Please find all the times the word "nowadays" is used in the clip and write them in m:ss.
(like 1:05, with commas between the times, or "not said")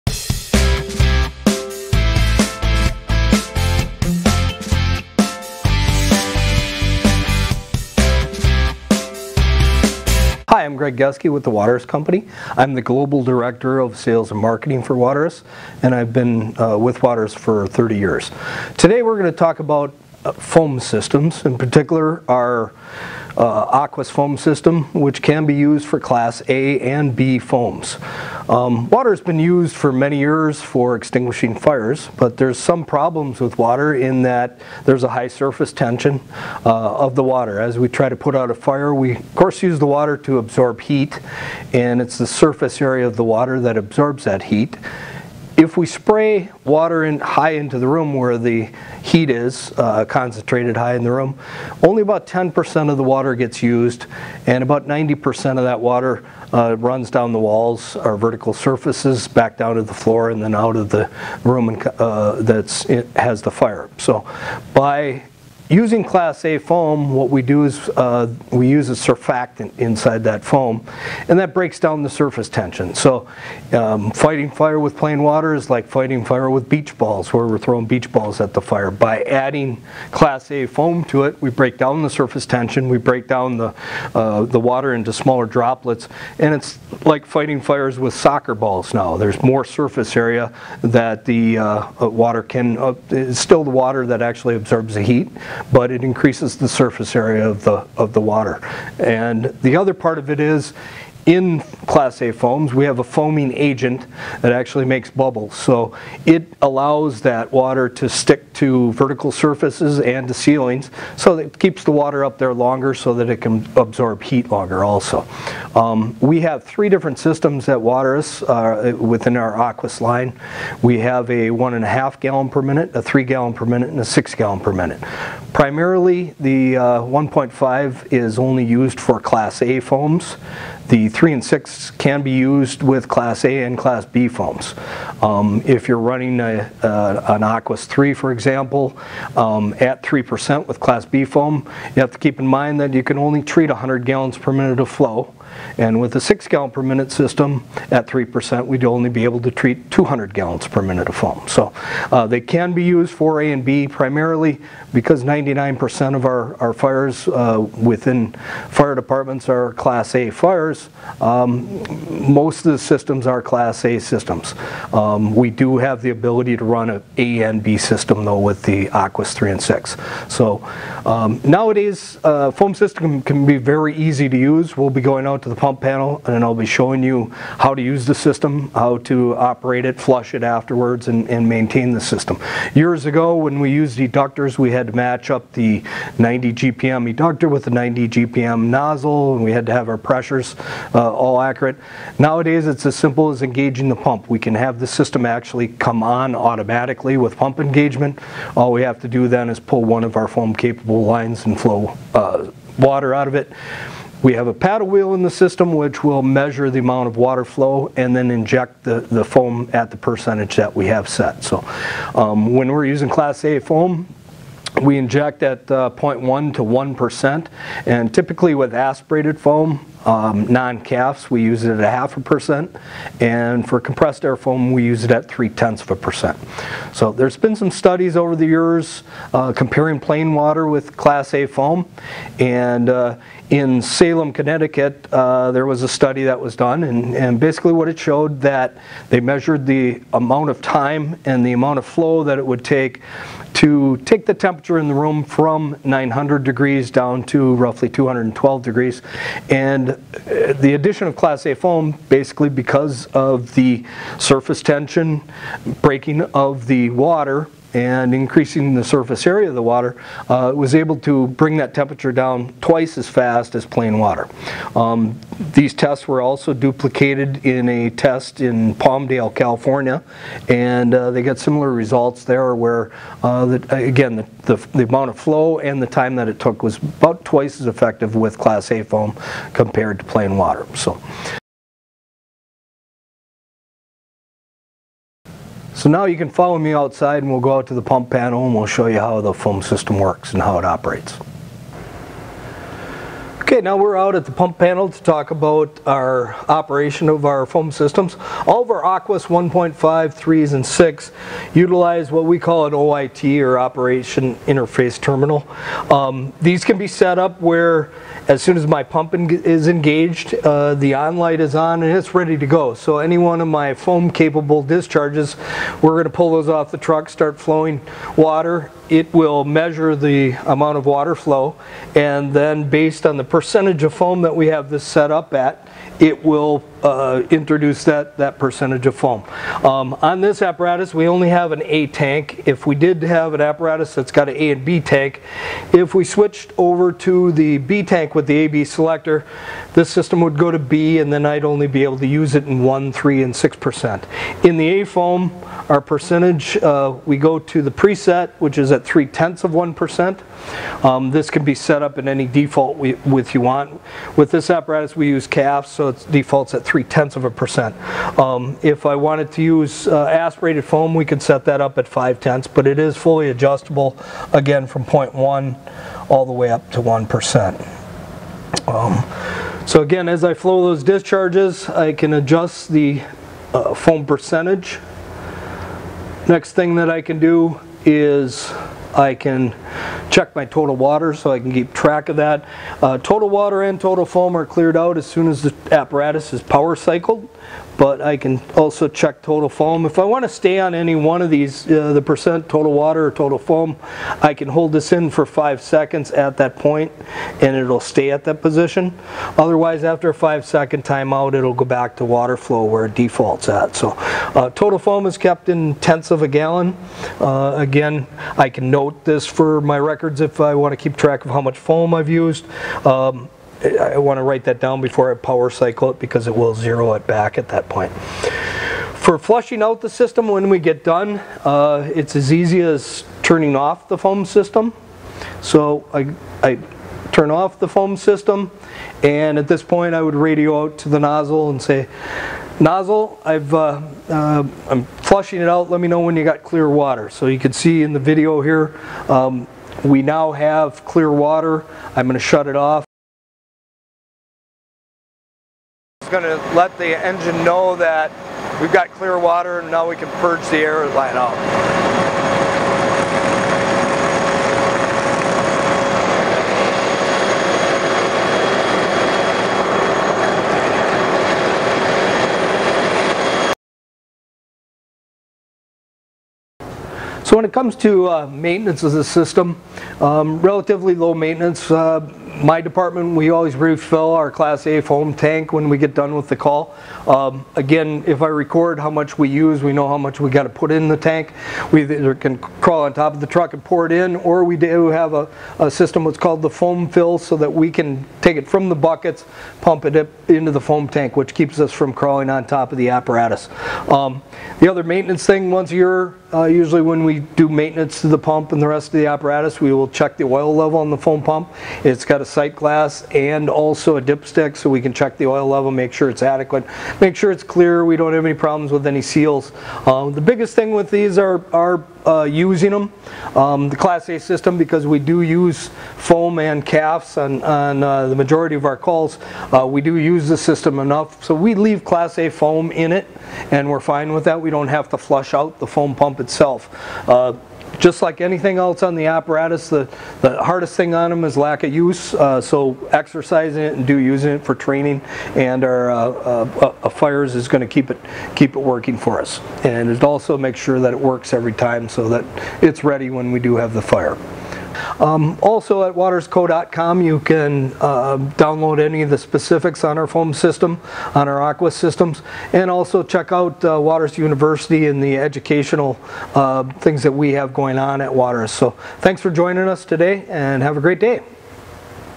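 2:51, 3:12.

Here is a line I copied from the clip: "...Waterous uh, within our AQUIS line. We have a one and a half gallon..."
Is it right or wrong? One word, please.
right.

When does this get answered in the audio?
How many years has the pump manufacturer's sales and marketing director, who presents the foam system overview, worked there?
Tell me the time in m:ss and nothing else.
0:17.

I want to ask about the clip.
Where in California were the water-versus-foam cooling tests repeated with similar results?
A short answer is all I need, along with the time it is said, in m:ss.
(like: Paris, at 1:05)
Palmdale, at 4:28.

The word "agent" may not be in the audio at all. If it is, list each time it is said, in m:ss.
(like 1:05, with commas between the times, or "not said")
1:43.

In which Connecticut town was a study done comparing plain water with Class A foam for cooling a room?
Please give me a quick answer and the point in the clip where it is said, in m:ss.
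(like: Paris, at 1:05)
Salem, at 3:53.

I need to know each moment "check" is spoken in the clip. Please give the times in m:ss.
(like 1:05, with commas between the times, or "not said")
6:20, 6:28, 8:19, 8:24, 9:13.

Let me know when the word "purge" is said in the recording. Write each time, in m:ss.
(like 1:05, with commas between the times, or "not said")
7:30.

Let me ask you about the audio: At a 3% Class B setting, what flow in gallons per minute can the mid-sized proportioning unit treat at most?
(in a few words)
100 gallons per minute.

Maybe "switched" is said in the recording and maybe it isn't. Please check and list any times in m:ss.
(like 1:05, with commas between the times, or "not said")
5:36.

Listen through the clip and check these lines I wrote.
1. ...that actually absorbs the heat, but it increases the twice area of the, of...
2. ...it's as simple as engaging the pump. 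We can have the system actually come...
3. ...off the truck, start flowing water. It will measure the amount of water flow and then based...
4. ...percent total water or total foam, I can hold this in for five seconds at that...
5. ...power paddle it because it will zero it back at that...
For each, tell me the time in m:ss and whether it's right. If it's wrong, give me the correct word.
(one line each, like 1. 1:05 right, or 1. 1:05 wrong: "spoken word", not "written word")
1. 1:34 wrong: "surface", not "twice"
2. 3:12 right
3. 5:16 right
4. 6:32 right
5. 6:55 wrong: "cycle", not "paddle".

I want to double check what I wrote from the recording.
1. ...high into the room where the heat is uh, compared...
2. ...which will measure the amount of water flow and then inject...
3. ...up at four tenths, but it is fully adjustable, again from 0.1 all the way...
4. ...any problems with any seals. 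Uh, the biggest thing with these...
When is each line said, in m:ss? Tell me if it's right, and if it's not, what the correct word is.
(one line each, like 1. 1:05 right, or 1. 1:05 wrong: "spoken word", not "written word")
1. 0:47 wrong: "concentrated", not "compared"
2. 3:25 right
3. 6:01 wrong: "five", not "four"
4. 8:28 right.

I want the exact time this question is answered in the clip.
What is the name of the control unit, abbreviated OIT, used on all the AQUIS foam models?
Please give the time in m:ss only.
5:03.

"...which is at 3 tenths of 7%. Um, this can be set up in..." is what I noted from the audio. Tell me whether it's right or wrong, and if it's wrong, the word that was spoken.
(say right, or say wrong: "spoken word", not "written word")
wrong: "1", not "7".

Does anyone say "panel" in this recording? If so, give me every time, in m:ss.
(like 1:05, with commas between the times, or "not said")
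2:55, 4:48, 4:54.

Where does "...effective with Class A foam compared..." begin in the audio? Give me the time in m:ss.
4:37.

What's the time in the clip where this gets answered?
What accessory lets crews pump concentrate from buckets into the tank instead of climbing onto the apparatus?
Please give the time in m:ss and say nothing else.
8:06.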